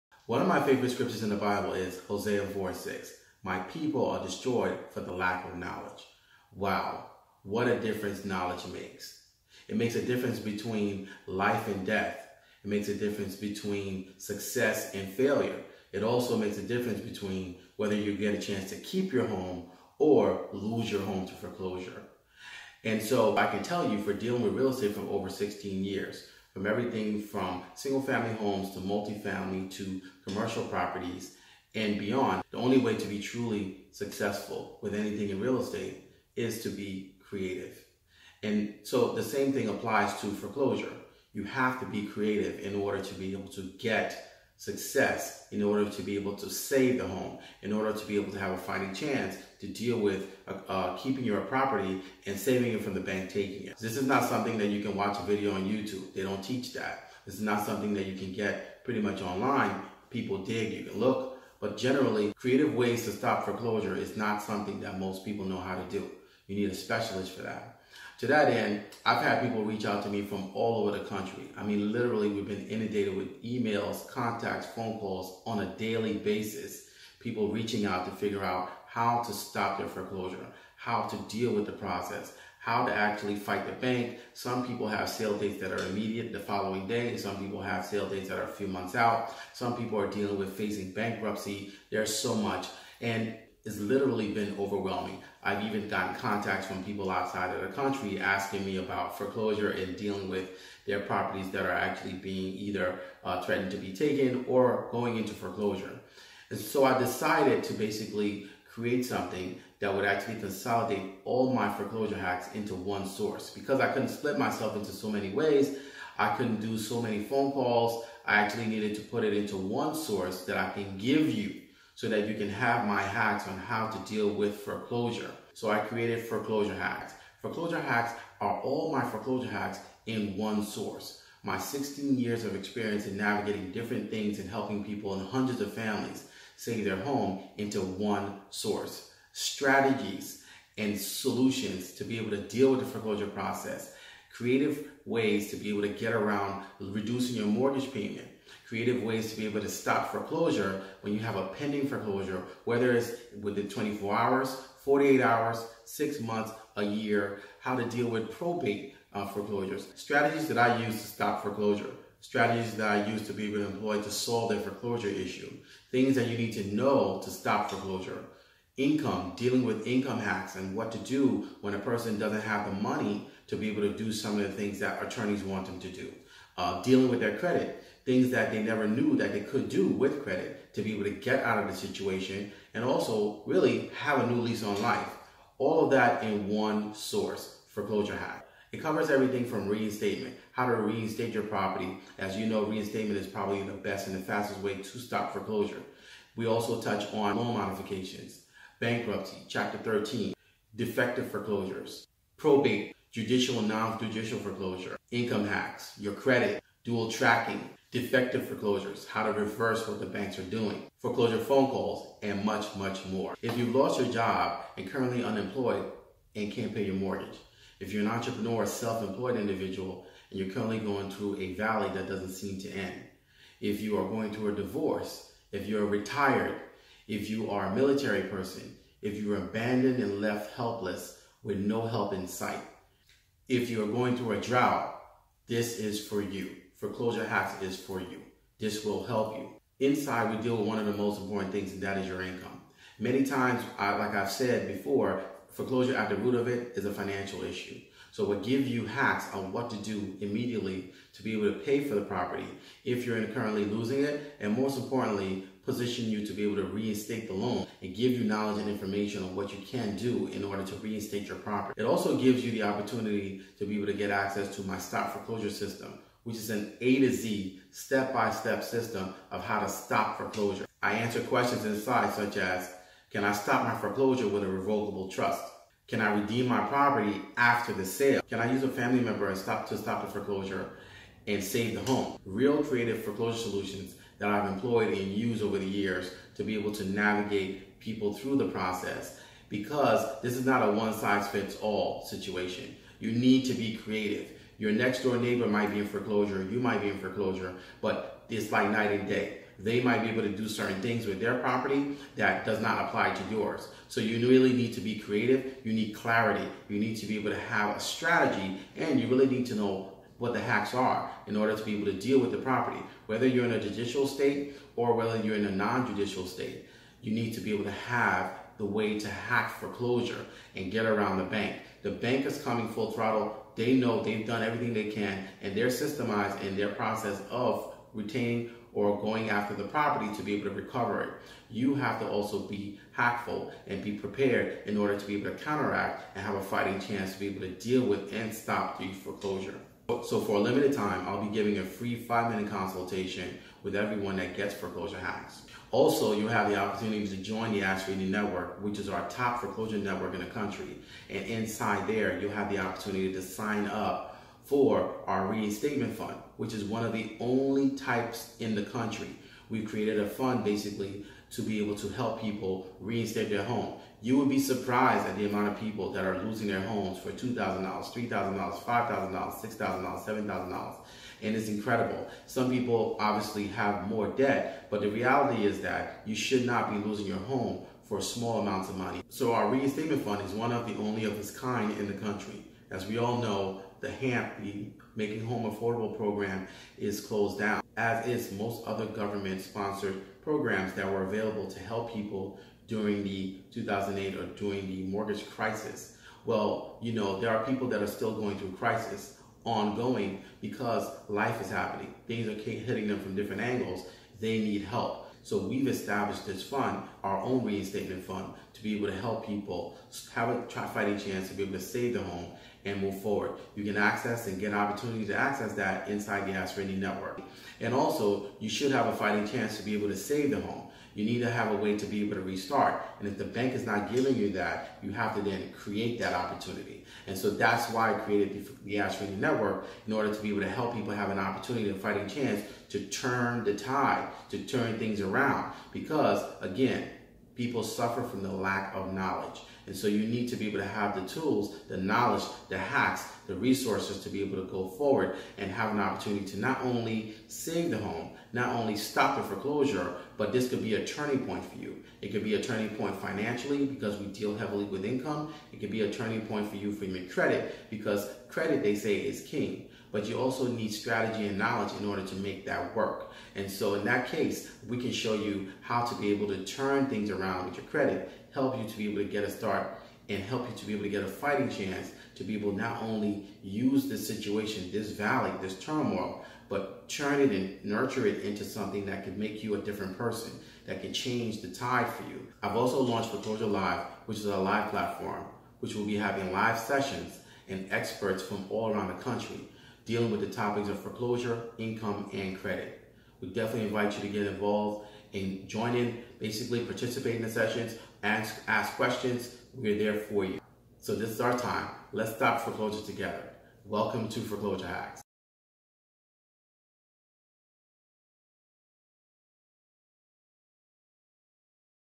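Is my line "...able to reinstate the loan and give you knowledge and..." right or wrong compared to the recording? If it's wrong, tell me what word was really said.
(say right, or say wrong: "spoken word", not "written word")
right.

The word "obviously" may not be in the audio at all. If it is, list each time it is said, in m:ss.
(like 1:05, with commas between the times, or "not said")
6:12.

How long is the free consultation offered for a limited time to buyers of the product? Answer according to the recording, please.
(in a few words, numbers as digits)
5 minutes.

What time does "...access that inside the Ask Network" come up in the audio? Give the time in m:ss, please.
6:55.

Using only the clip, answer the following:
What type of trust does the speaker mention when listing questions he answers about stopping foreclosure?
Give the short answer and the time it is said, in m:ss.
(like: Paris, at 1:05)
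Revocable trust, at 4:34.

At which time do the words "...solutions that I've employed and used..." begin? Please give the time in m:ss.
4:43.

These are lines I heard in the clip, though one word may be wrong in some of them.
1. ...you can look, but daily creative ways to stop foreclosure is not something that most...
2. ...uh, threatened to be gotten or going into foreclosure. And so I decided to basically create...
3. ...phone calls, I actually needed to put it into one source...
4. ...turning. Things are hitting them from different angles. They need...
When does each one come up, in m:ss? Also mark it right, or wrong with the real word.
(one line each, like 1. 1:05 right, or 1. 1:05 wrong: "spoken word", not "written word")
1. 1:00 wrong: "generally", not "daily"
2. 1:43 wrong: "taken", not "gotten"
3. 1:57 right
4. 6:41 wrong: "happening", not "turning".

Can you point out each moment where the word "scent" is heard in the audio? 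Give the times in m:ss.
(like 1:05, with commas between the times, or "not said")
not said.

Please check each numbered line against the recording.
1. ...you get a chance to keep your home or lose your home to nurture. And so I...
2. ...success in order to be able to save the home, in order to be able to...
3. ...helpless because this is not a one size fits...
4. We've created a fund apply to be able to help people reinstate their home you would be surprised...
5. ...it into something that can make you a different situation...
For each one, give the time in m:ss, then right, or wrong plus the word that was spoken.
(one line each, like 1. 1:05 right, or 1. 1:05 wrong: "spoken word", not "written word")
1. 0:17 wrong: "foreclosure", not "nurture"
2. 0:44 right
3. 4:48 wrong: "process", not "helpless"
4. 5:59 wrong: "basically", not "apply"
5. 7:58 wrong: "person", not "situation".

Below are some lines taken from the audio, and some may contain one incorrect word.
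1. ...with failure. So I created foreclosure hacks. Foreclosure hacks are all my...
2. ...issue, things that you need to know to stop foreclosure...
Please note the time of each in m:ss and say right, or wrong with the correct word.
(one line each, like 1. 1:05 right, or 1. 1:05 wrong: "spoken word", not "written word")
1. 2:04 wrong: "foreclosure", not "failure"
2. 2:45 right.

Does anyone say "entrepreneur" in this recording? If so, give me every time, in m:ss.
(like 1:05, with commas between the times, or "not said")
3:38.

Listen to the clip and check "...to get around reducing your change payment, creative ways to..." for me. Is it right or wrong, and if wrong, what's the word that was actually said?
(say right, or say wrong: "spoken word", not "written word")
wrong: "mortgage", not "change".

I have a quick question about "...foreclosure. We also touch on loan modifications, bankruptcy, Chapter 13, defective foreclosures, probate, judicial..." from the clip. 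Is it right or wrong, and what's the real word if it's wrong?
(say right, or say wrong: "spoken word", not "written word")
right.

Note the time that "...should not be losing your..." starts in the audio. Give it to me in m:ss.
6:16.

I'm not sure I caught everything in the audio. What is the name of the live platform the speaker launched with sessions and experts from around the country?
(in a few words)
Foreclosure Live.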